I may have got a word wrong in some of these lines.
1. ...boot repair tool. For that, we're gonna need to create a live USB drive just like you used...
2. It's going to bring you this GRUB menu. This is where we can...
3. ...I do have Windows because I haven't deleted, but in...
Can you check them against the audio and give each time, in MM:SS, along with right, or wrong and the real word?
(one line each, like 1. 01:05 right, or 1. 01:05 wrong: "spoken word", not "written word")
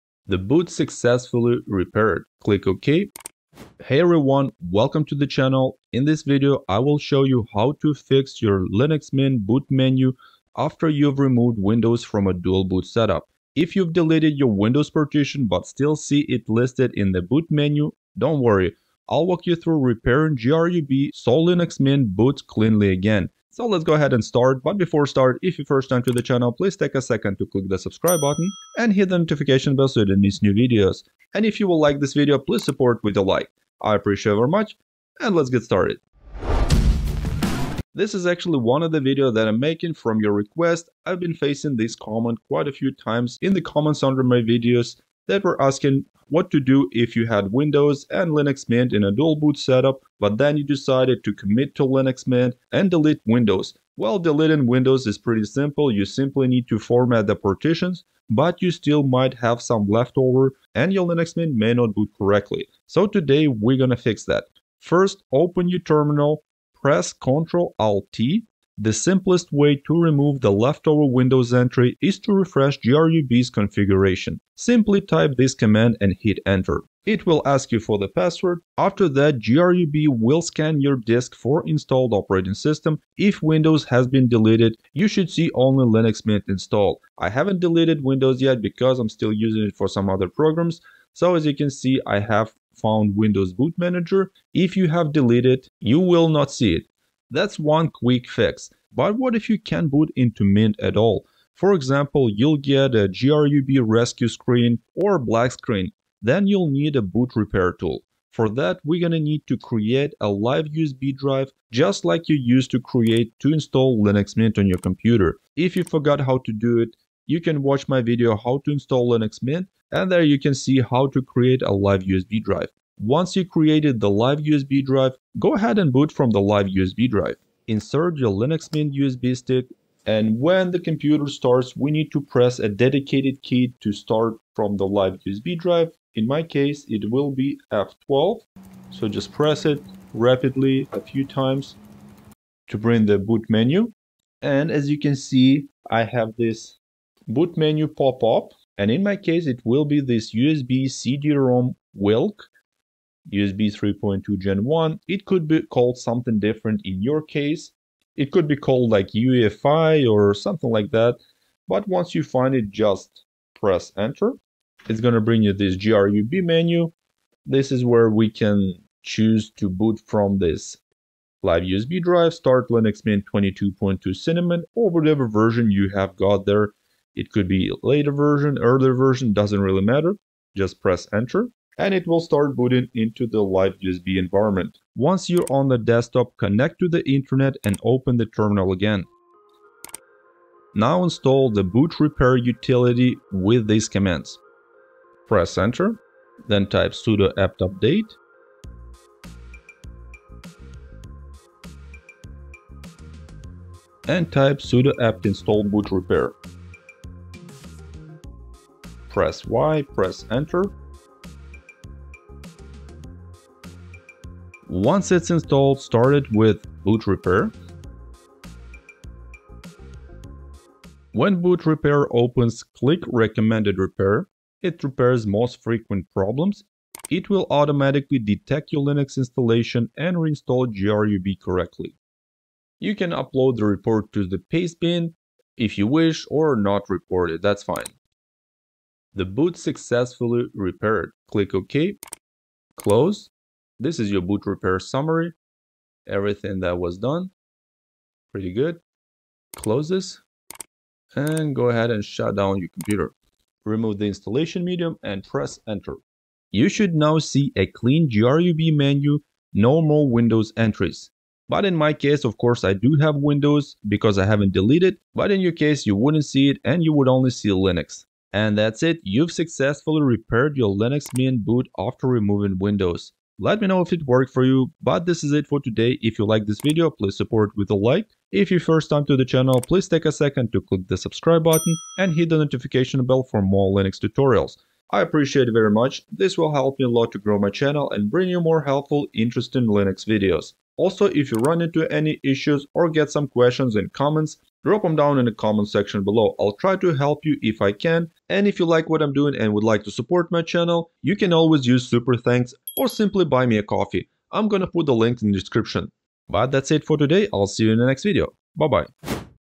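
1. 01:47 right
2. 02:44 right
3. 04:22 right.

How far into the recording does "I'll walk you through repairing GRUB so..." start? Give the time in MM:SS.
00:19.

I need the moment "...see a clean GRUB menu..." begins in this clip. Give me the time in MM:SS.
04:17.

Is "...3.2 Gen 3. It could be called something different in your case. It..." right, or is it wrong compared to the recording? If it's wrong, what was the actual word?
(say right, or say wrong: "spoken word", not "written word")
wrong: "1", not "3".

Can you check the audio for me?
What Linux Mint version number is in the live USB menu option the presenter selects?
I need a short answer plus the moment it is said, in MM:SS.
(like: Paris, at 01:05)
22.2, at 02:53.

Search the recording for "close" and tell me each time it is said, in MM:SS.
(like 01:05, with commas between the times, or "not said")
04:02, 04:09.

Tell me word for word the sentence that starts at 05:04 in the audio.
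I'm gonna put the link in the description.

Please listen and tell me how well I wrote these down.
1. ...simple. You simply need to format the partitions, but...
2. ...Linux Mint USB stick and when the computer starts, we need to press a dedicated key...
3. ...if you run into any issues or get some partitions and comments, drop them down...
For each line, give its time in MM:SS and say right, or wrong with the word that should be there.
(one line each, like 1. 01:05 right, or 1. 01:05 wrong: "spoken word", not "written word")
1. 00:55 right
2. 02:08 right
3. 04:51 wrong: "questions", not "partitions".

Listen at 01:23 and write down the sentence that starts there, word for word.
If Windows has been deleted, you should see only Linux Mint installed.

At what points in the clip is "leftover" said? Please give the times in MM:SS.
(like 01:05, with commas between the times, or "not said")
00:59, 01:10.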